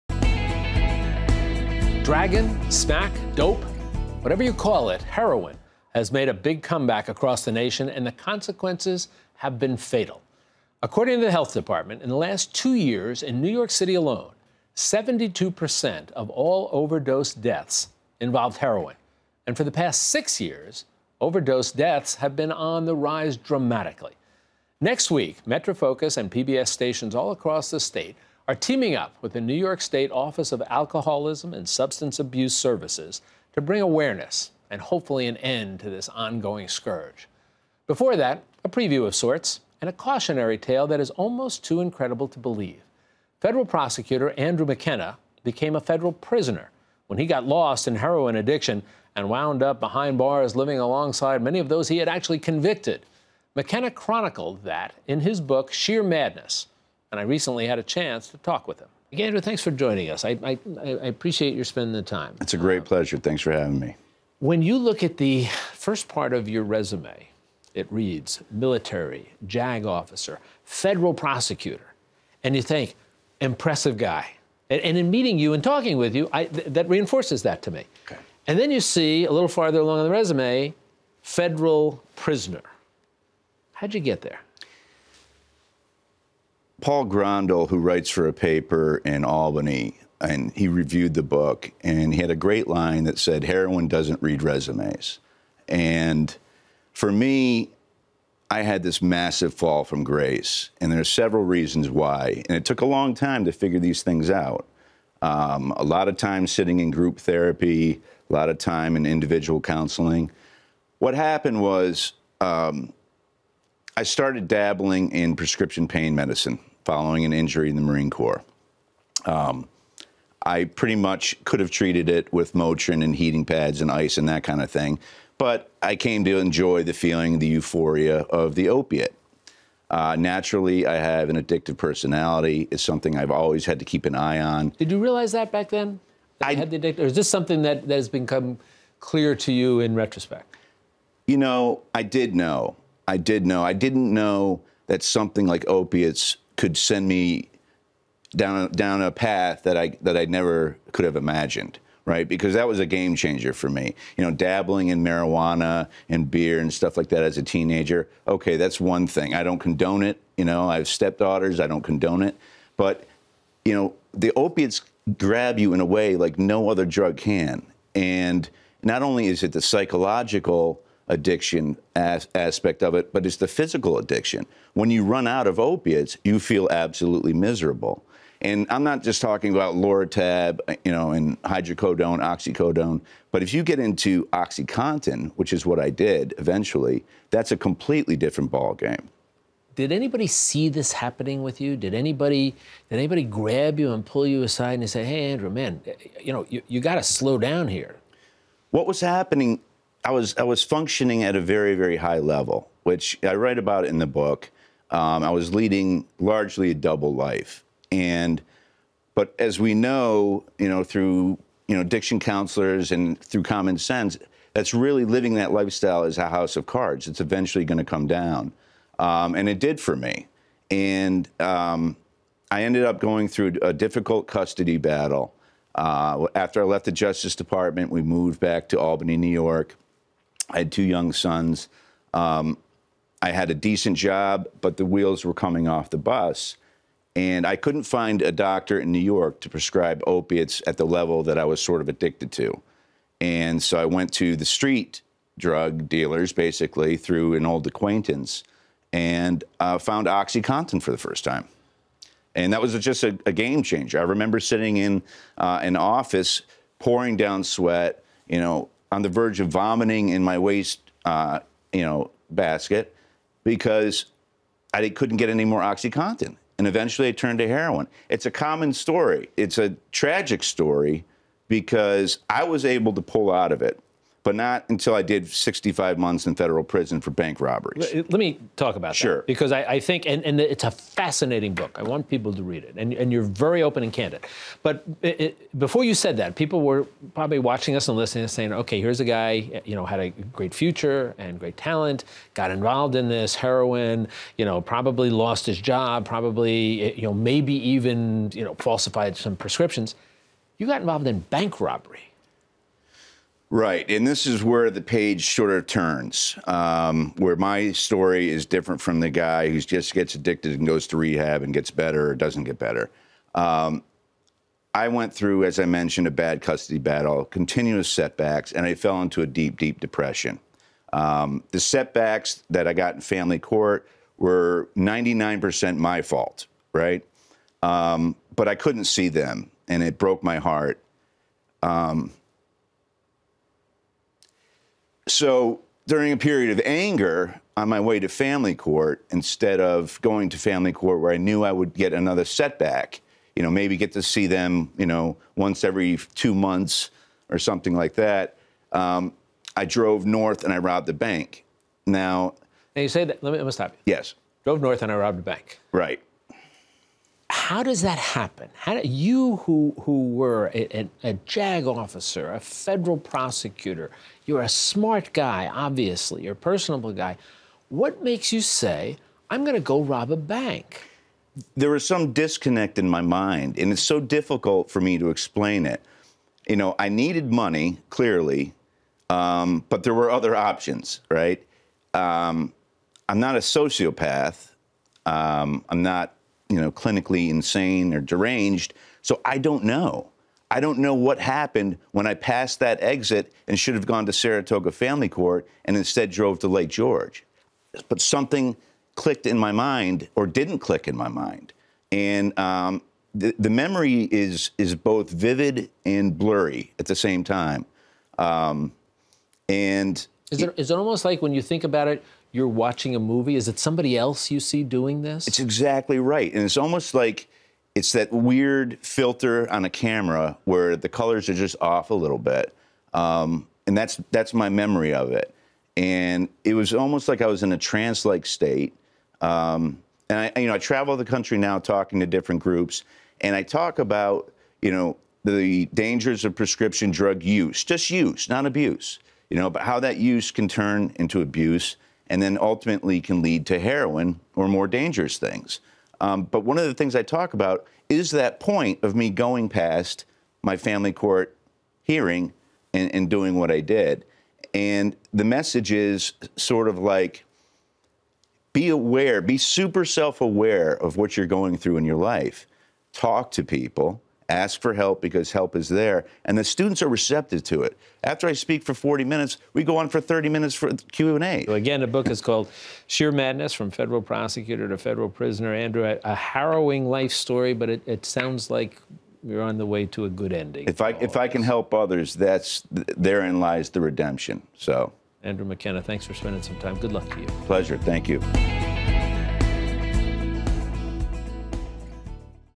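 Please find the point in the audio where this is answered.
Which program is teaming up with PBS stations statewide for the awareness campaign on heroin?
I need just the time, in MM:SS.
00:25.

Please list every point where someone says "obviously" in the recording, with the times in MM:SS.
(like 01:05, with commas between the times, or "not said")
06:05.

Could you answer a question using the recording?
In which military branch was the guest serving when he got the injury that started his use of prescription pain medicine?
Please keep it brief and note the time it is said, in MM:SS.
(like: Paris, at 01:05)
Marine Corps, at 01:57.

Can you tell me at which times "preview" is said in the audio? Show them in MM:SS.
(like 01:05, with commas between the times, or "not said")
00:38.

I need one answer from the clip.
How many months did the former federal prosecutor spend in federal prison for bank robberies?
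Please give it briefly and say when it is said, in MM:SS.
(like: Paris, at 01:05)
65, at 04:35.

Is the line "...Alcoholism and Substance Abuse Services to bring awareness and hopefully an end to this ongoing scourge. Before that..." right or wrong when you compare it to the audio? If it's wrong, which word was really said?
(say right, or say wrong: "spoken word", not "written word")
right.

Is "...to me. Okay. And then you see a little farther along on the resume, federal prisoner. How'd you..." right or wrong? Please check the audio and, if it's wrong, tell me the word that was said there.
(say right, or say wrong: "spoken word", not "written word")
right.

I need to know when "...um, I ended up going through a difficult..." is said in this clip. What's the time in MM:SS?
03:41.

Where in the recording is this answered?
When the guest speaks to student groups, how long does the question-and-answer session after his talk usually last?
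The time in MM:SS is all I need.
07:49.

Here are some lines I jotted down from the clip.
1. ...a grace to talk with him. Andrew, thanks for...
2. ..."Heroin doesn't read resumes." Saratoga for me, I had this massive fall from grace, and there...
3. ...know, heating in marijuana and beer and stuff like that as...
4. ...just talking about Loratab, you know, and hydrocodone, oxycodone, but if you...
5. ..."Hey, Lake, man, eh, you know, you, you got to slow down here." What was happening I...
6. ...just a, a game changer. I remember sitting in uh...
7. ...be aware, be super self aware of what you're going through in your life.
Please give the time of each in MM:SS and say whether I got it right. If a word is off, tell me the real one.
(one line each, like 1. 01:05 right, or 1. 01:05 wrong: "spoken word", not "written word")
1. 00:57 wrong: "chance", not "grace"
2. 01:33 wrong: "And", not "Saratoga"
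3. 02:34 wrong: "dabbling", not "heating"
4. 02:59 right
5. 03:15 wrong: "Andrew", not "Lake"
6. 04:12 right
7. 07:38 right.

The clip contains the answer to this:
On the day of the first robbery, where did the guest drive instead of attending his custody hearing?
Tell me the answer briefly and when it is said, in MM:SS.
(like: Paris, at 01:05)
Lake George, at 06:36.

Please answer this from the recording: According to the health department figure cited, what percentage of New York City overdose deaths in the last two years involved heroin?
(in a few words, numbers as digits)
72%.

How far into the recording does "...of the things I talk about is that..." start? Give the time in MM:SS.
07:26.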